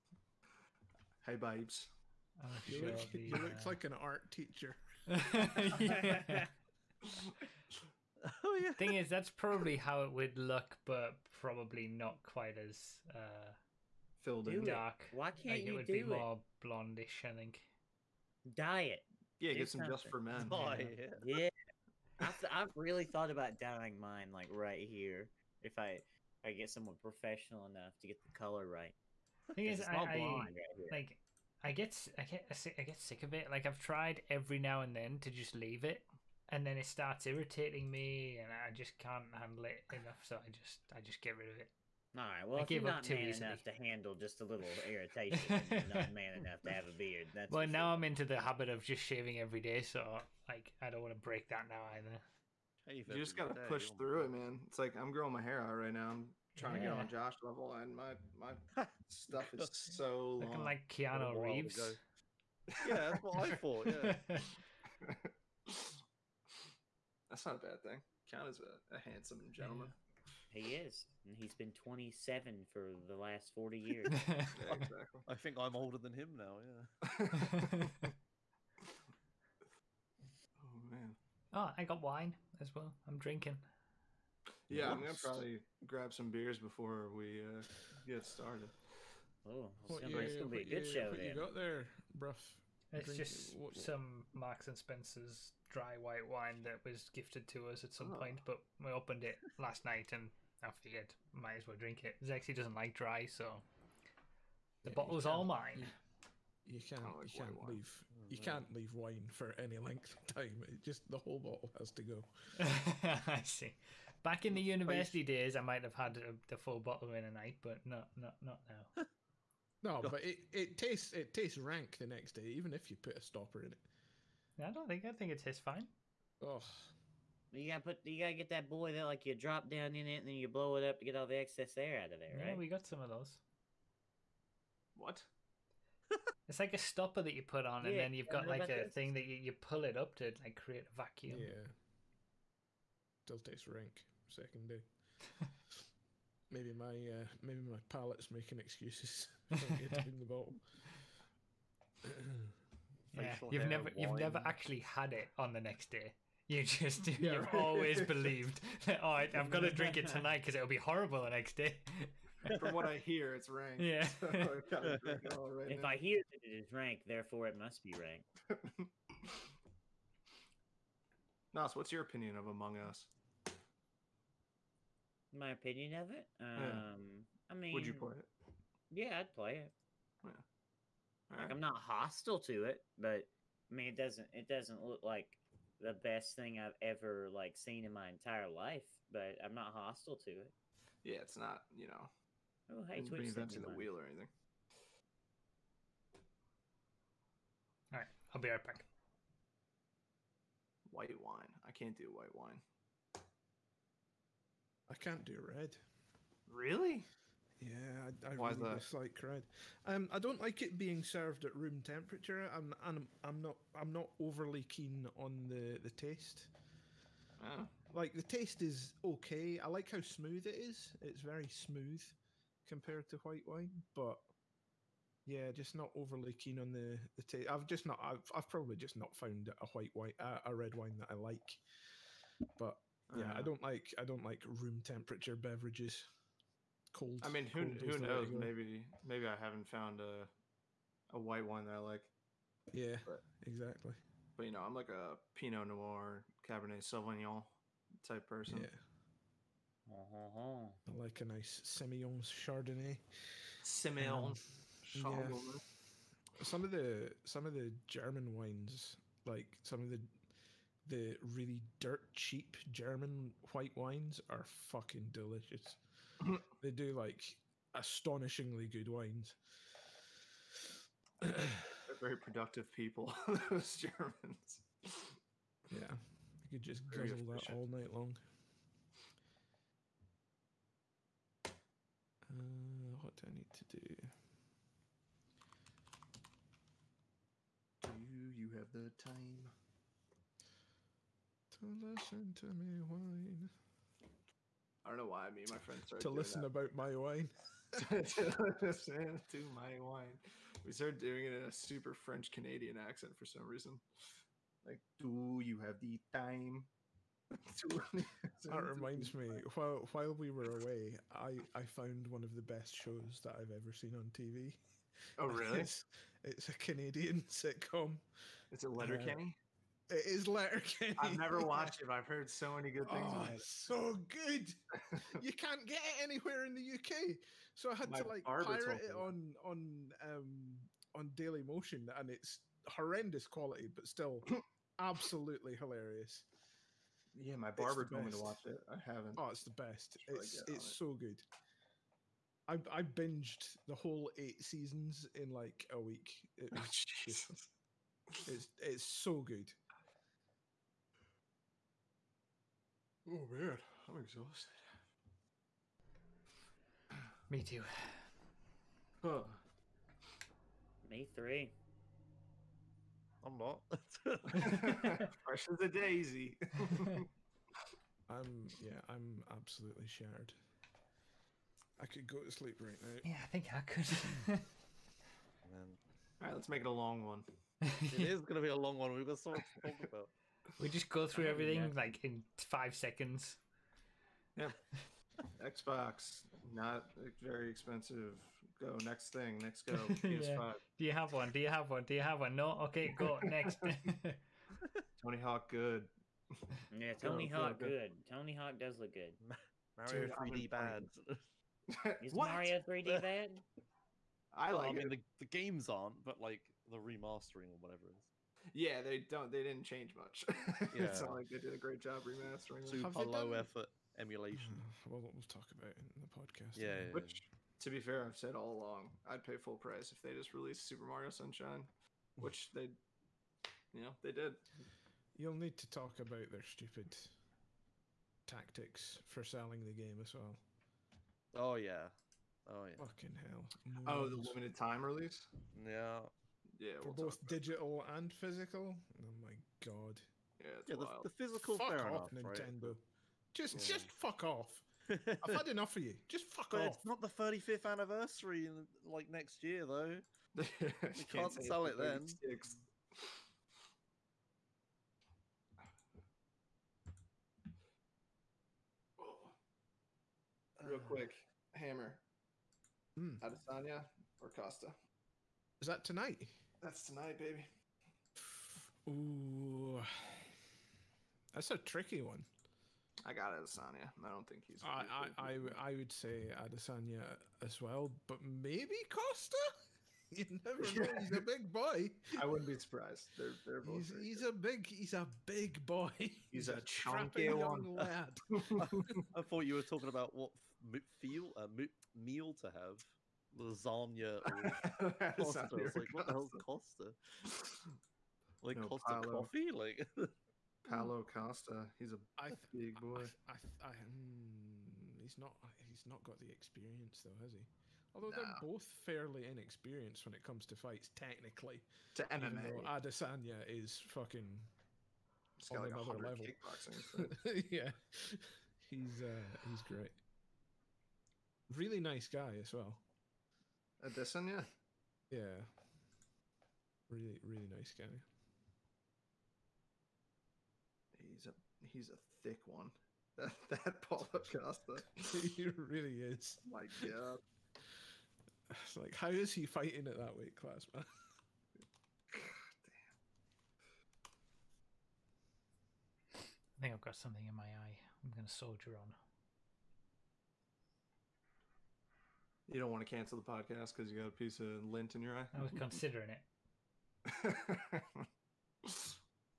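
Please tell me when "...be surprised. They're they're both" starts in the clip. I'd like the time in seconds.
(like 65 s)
482 s.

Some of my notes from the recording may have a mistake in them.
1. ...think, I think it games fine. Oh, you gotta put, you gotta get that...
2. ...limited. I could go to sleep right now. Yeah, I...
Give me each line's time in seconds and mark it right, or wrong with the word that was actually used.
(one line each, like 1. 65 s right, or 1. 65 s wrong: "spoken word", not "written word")
1. 124 s wrong: "tastes", not "games"
2. 369 s wrong: "shattered", not "limited".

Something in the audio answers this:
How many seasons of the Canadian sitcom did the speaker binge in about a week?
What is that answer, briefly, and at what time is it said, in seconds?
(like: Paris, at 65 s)
8, at 344 s.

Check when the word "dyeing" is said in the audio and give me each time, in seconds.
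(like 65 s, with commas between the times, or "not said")
23 s.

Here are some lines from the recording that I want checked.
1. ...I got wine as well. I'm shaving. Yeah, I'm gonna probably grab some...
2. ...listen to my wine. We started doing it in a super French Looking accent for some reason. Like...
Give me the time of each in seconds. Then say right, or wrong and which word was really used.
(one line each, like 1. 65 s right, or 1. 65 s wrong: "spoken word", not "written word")
1. 81 s wrong: "drinking", not "shaving"
2. 298 s wrong: "Canadian", not "Looking".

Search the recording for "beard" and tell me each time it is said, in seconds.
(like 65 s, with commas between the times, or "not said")
46 s.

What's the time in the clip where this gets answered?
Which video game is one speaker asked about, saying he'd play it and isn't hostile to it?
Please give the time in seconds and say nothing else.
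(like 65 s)
172 s.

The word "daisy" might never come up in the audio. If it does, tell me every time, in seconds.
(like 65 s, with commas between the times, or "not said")
365 s.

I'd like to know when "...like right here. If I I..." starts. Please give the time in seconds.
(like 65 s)
24 s.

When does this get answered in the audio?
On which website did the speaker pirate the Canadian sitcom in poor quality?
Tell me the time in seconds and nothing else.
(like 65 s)
331 s.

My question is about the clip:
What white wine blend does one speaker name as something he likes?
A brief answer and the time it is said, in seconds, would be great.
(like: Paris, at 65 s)
Semillon Chardonnay, at 251 s.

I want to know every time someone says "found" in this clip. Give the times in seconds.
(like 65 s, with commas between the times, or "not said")
229 s, 239 s, 311 s.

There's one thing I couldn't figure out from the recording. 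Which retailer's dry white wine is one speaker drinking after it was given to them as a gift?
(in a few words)
Marks and Spencer's.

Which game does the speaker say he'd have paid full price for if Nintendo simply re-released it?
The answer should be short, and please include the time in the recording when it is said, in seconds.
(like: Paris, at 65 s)
Super Mario Sunshine, at 420 s.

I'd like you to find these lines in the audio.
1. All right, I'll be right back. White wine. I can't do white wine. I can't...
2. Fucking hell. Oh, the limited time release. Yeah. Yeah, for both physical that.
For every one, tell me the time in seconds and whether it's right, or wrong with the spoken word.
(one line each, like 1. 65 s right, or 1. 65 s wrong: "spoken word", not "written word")
1. 197 s right
2. 432 s wrong: "digital", not "physical".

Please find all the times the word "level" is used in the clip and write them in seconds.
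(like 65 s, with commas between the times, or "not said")
57 s, 515 s.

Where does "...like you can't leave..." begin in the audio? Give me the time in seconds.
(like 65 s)
107 s.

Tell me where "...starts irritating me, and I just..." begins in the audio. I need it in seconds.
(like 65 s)
36 s.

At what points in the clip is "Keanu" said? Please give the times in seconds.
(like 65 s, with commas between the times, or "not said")
60 s, 68 s.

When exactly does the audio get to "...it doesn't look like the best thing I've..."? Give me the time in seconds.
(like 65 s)
184 s.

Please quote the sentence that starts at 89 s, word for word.
Oh, it's gonna, be, gonna be a good you, show.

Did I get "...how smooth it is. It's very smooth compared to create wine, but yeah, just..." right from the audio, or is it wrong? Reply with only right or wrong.
wrong.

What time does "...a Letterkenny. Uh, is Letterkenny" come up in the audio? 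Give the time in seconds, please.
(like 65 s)
318 s.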